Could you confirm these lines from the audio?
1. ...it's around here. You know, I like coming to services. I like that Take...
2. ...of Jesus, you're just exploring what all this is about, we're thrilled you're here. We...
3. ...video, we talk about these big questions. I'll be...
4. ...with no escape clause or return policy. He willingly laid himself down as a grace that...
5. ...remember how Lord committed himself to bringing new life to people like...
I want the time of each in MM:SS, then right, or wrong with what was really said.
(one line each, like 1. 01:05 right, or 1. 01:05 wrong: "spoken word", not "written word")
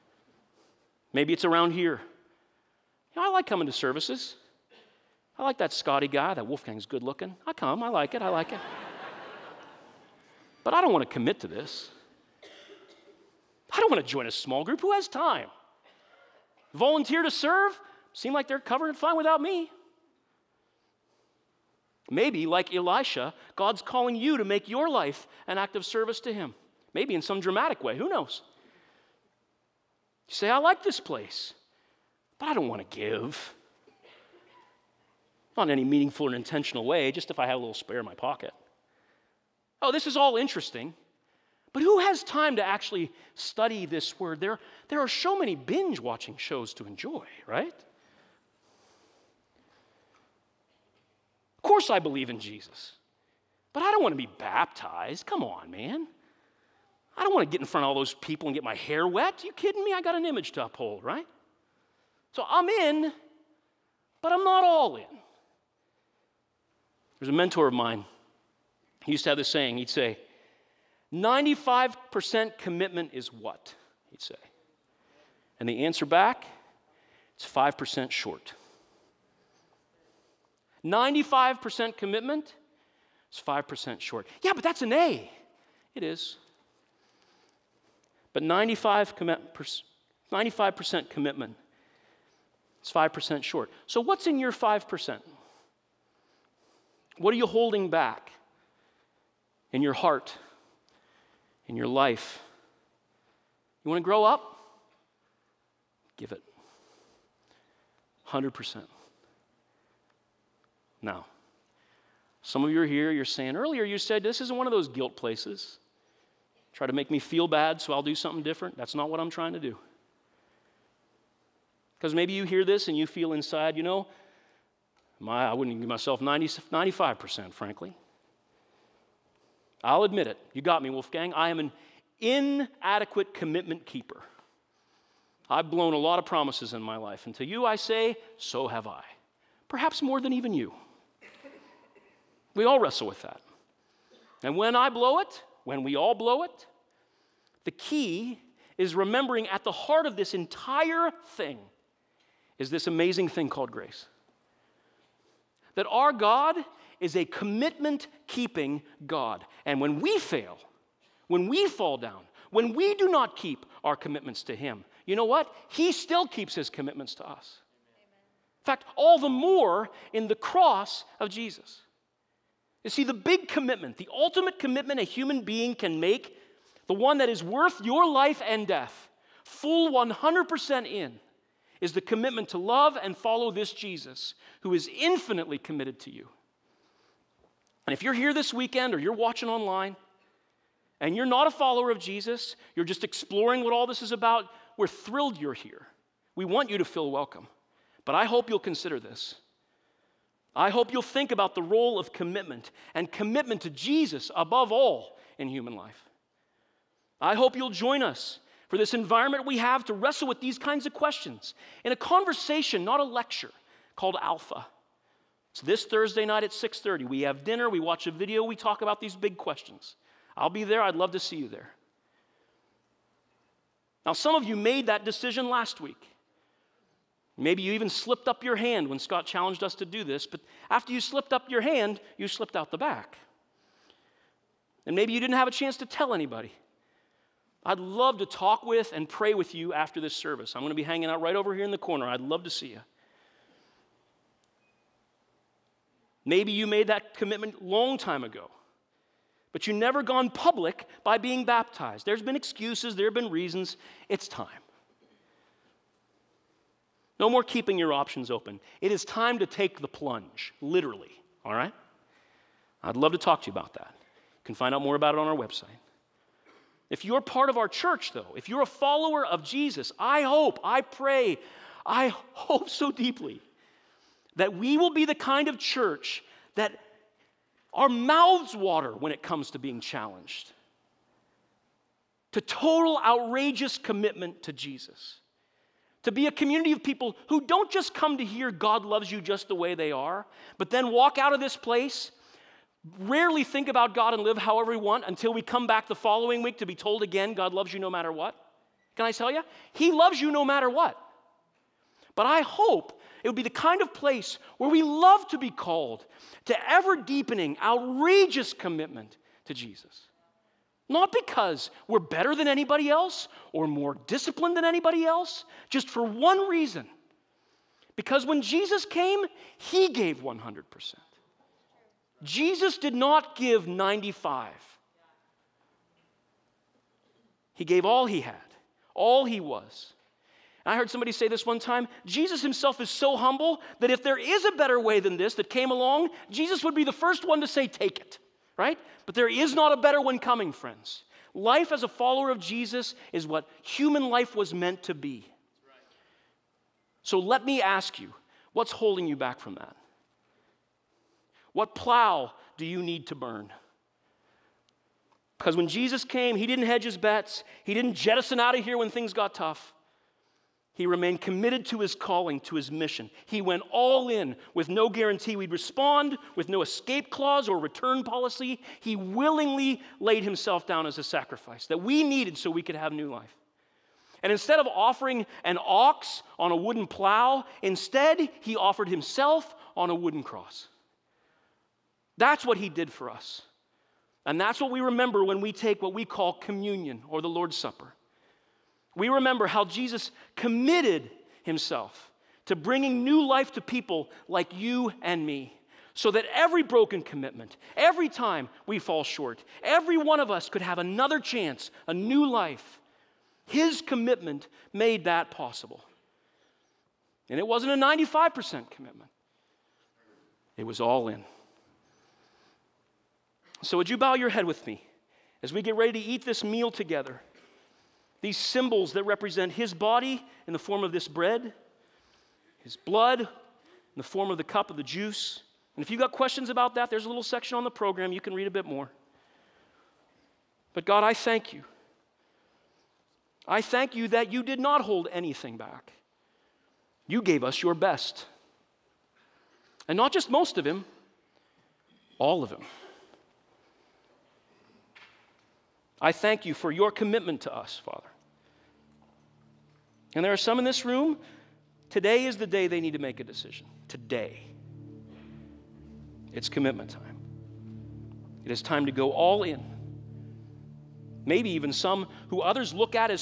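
1. 00:01 wrong: "Scotty", not "Take"
2. 03:11 right
3. 03:38 right
4. 06:06 wrong: "sacrifice", not "grace"
5. 06:29 wrong: "Jesus", not "Lord".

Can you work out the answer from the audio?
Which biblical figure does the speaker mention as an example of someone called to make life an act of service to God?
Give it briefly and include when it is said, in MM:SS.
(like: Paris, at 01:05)
Elisha, at 00:22.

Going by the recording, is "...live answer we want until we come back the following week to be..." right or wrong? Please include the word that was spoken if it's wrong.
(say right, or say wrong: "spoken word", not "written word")
wrong: "however", not "answer".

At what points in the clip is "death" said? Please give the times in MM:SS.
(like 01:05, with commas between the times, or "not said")
02:58.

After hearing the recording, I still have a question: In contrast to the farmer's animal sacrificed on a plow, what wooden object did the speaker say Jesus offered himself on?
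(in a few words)
a wooden cross.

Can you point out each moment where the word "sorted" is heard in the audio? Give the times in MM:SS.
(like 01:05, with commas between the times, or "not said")
not said.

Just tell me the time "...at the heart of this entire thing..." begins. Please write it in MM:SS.
02:29.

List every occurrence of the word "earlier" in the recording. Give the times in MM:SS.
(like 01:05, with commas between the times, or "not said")
01:53.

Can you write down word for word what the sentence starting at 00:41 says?
But who has time to actually study this word?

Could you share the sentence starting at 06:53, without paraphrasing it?
So, would you bow your head with me as we get ready to eat this meal together?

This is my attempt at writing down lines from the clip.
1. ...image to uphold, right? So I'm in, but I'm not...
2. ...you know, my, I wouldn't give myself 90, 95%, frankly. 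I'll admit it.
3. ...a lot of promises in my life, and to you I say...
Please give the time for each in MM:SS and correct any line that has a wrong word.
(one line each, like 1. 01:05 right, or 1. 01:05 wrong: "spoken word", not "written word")
1. 01:00 right
2. 02:03 right
3. 02:15 right.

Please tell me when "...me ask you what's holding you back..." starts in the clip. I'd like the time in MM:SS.
05:47.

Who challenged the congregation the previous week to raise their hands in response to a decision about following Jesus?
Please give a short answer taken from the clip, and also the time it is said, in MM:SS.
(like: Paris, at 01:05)
Scott, at 03:48.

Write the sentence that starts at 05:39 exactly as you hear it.
But there is not a better one coming, friends.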